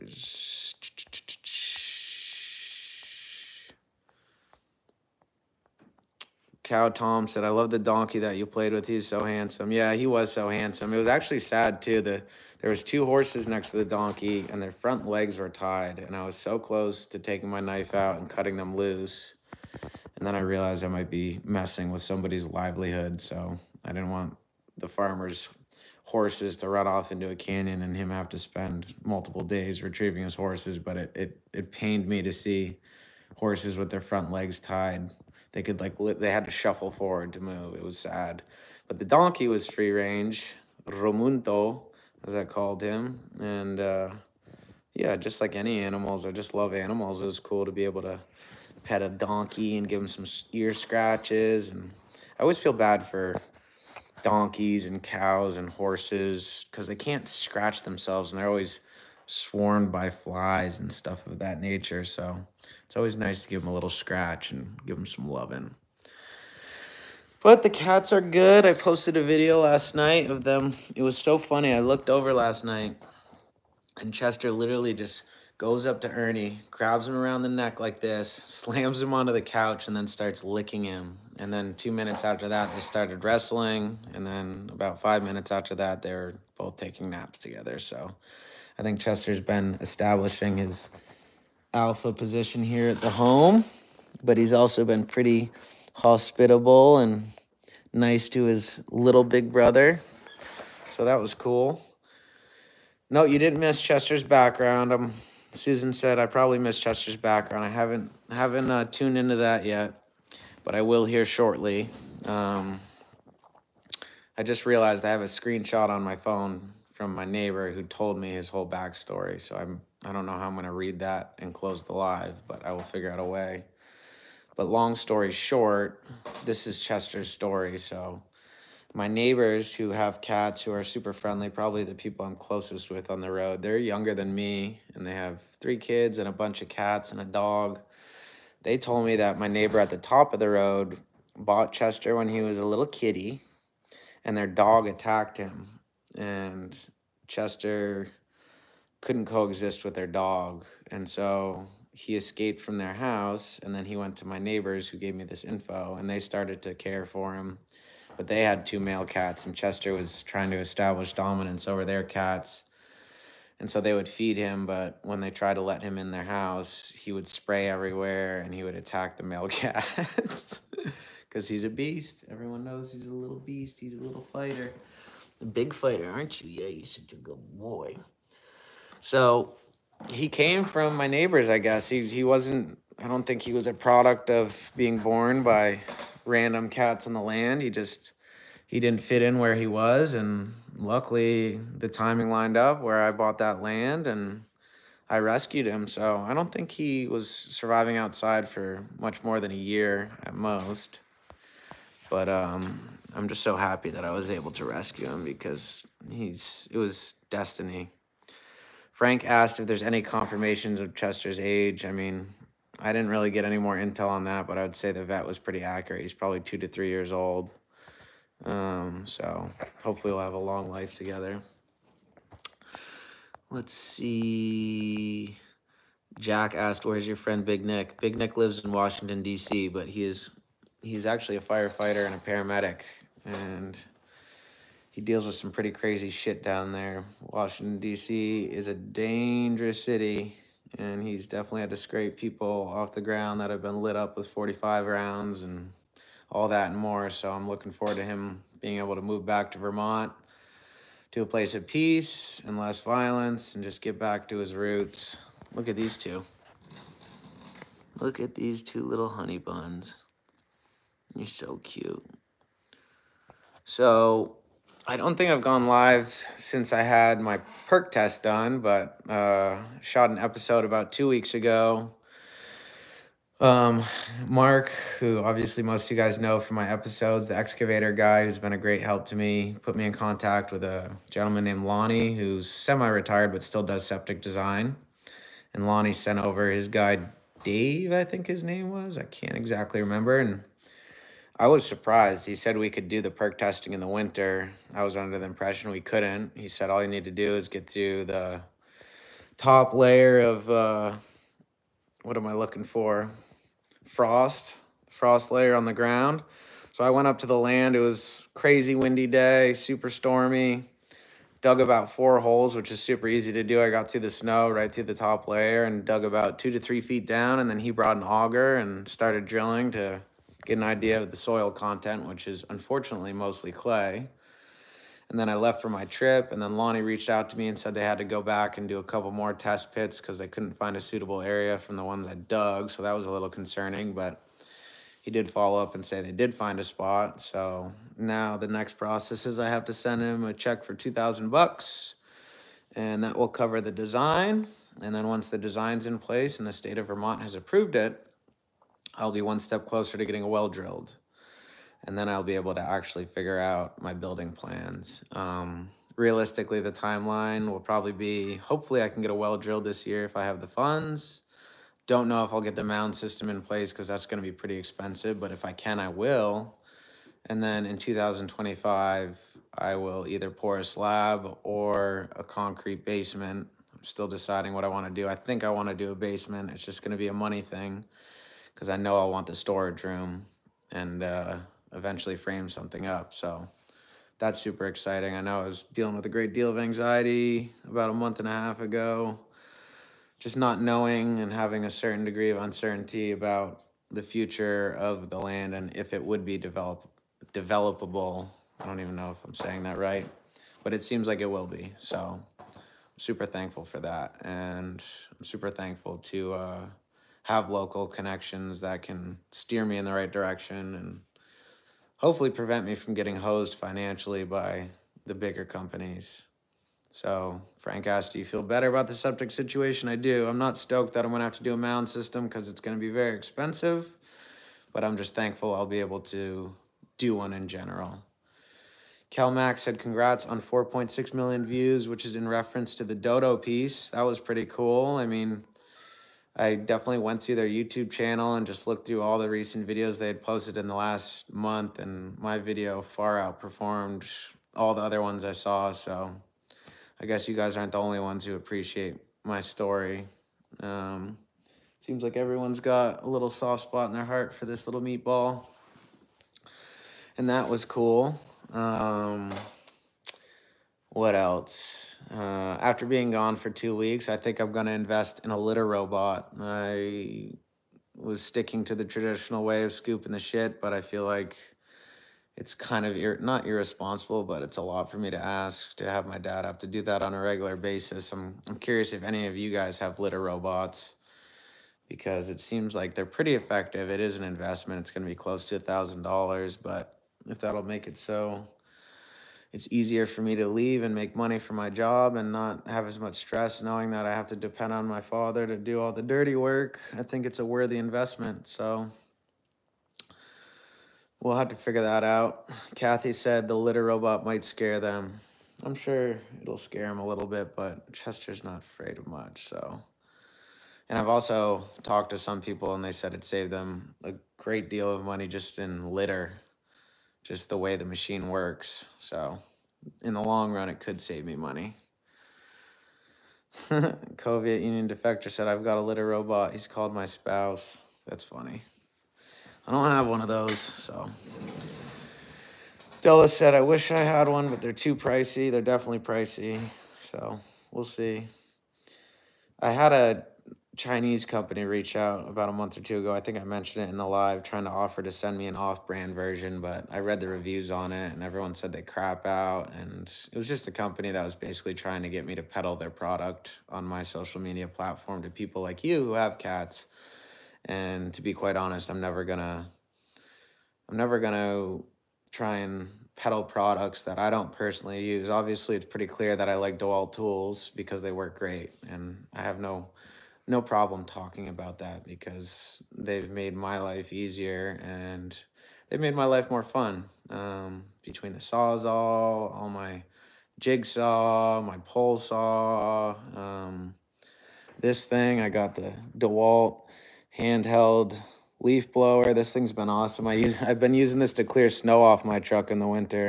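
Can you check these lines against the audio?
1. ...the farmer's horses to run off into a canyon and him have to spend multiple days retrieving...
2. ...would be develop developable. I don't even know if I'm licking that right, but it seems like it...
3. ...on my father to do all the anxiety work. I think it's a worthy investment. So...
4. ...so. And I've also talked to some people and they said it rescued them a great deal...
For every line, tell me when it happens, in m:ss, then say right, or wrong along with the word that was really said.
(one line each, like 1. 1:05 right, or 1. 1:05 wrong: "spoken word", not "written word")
1. 0:24 right
2. 6:36 wrong: "saying", not "licking"
3. 8:14 wrong: "dirty", not "anxiety"
4. 8:29 wrong: "saved", not "rescued".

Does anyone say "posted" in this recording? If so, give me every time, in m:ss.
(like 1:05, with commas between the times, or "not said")
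1:08, 7:20.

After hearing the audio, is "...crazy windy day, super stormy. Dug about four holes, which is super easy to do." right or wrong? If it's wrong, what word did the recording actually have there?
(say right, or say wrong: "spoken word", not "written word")
right.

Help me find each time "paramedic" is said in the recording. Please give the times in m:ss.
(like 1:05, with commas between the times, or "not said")
3:52.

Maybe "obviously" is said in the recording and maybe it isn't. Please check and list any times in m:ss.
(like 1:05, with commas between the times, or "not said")
4:35, 9:25.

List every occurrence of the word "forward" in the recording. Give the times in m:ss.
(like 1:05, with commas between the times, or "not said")
0:36, 4:07.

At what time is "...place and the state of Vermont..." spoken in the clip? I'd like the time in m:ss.
5:45.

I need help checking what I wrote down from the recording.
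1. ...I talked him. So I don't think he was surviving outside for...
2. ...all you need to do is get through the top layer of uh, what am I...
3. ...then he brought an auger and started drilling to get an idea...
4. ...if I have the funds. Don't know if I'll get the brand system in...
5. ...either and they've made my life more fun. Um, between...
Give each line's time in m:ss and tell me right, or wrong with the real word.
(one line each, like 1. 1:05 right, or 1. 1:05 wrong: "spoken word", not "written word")
1. 3:15 wrong: "rescued", not "talked"
2. 4:56 right
3. 5:17 right
4. 6:00 wrong: "mound", not "brand"
5. 9:34 wrong: "easier", not "either".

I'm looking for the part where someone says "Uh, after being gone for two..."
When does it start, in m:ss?
7:42.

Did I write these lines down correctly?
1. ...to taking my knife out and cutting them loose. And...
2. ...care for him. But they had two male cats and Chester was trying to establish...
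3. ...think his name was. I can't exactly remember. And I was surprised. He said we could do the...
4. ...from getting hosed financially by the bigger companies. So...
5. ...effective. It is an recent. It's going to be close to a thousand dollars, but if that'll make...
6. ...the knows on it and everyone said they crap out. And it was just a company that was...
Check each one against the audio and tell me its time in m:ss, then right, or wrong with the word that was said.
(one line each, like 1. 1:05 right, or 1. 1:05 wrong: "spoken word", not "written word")
1. 0:17 right
2. 2:36 right
3. 4:48 right
4. 6:52 right
5. 8:03 wrong: "investment", not "recent"
6. 9:07 wrong: "reviews", not "knows".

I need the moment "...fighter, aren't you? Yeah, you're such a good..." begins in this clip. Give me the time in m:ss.
2:55.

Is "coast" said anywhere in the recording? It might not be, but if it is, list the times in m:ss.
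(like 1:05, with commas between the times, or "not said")
not said.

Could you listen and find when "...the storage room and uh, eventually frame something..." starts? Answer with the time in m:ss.
6:19.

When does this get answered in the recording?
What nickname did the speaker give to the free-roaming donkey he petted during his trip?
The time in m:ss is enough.
0:40.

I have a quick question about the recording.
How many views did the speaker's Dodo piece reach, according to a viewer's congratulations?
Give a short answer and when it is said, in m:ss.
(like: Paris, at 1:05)
4.6 million, at 7:10.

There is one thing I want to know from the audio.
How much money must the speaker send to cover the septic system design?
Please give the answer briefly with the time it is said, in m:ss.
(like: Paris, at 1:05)
$2000, at 5:40.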